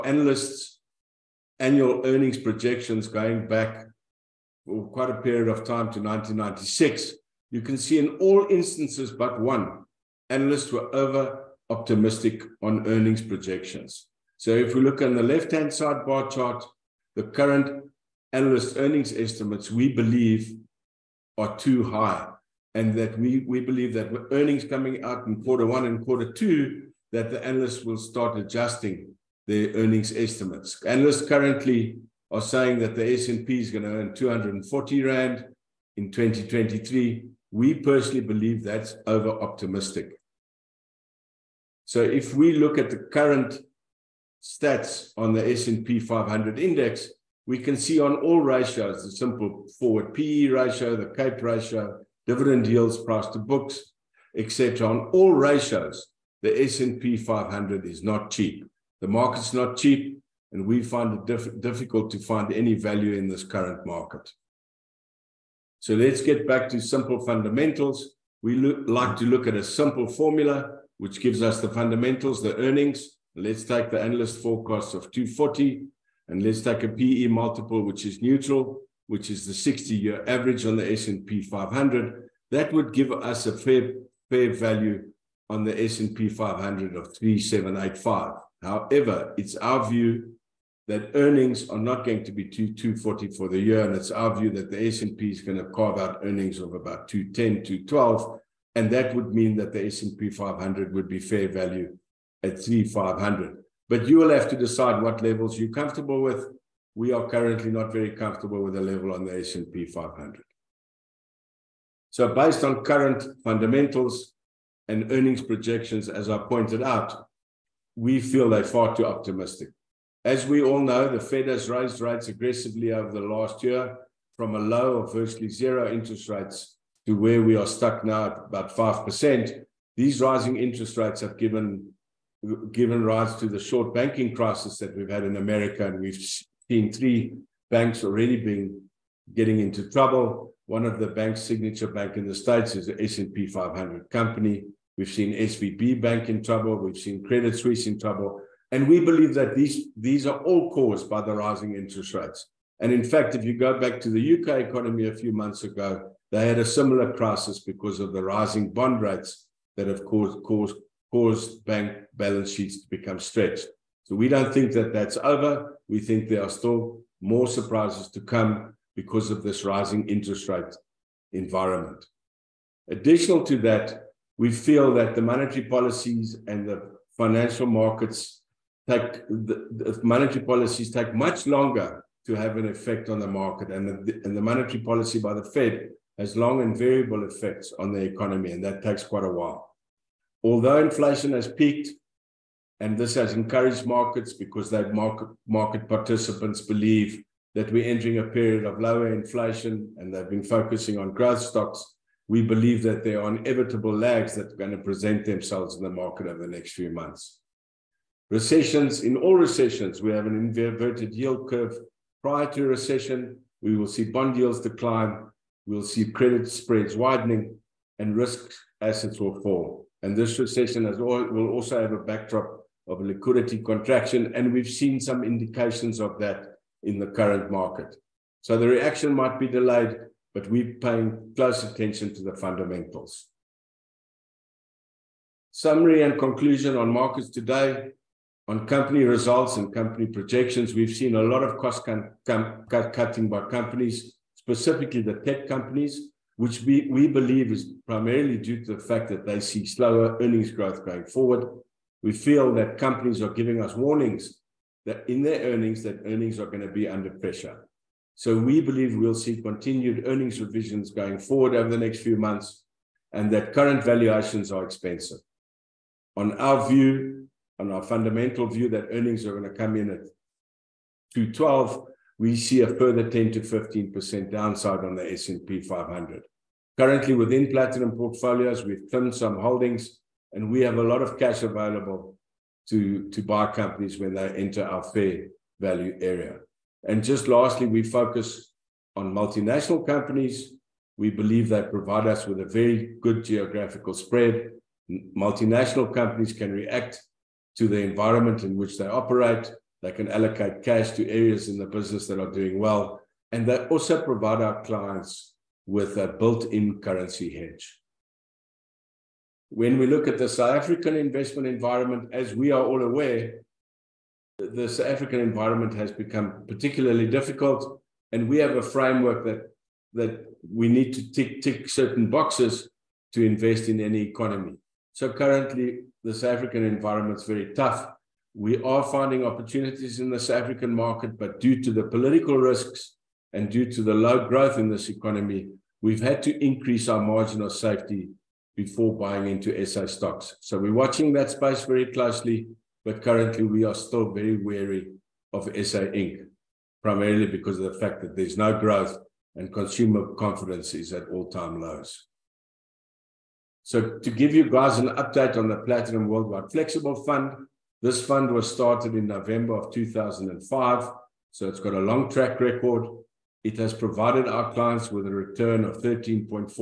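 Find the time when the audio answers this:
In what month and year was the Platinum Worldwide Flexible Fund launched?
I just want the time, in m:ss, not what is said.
5:59.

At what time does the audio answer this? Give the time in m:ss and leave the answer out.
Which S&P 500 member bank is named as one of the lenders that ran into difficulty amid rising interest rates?
2:21.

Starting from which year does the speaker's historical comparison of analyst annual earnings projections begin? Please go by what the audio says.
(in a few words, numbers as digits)
1996.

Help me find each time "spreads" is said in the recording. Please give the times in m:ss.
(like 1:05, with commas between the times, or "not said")
3:36, 4:53.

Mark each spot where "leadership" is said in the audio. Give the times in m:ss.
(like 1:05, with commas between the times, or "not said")
not said.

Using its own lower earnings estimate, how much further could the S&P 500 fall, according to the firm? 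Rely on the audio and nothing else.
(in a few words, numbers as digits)
10 to 15%.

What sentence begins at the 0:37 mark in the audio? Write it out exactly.
We personally believe that's over optimistic.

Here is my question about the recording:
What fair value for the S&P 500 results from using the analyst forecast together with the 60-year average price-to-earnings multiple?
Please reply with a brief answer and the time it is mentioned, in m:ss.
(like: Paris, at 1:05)
3785, at 1:27.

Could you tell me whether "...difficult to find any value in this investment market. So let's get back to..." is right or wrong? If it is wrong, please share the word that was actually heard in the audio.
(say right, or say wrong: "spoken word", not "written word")
wrong: "current", not "investment".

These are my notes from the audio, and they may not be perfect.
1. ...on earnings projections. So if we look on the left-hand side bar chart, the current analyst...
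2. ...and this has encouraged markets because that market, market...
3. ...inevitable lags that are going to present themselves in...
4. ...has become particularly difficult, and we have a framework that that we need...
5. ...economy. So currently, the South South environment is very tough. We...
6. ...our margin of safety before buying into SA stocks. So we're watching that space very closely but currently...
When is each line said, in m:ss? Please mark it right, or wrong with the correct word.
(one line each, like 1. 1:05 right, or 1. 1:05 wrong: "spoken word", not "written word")
1. 0:12 right
2. 3:12 right
3. 3:23 right
4. 5:15 right
5. 5:24 wrong: "African", not "South"
6. 5:36 right.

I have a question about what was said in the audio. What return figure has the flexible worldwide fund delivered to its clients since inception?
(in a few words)
13.48%.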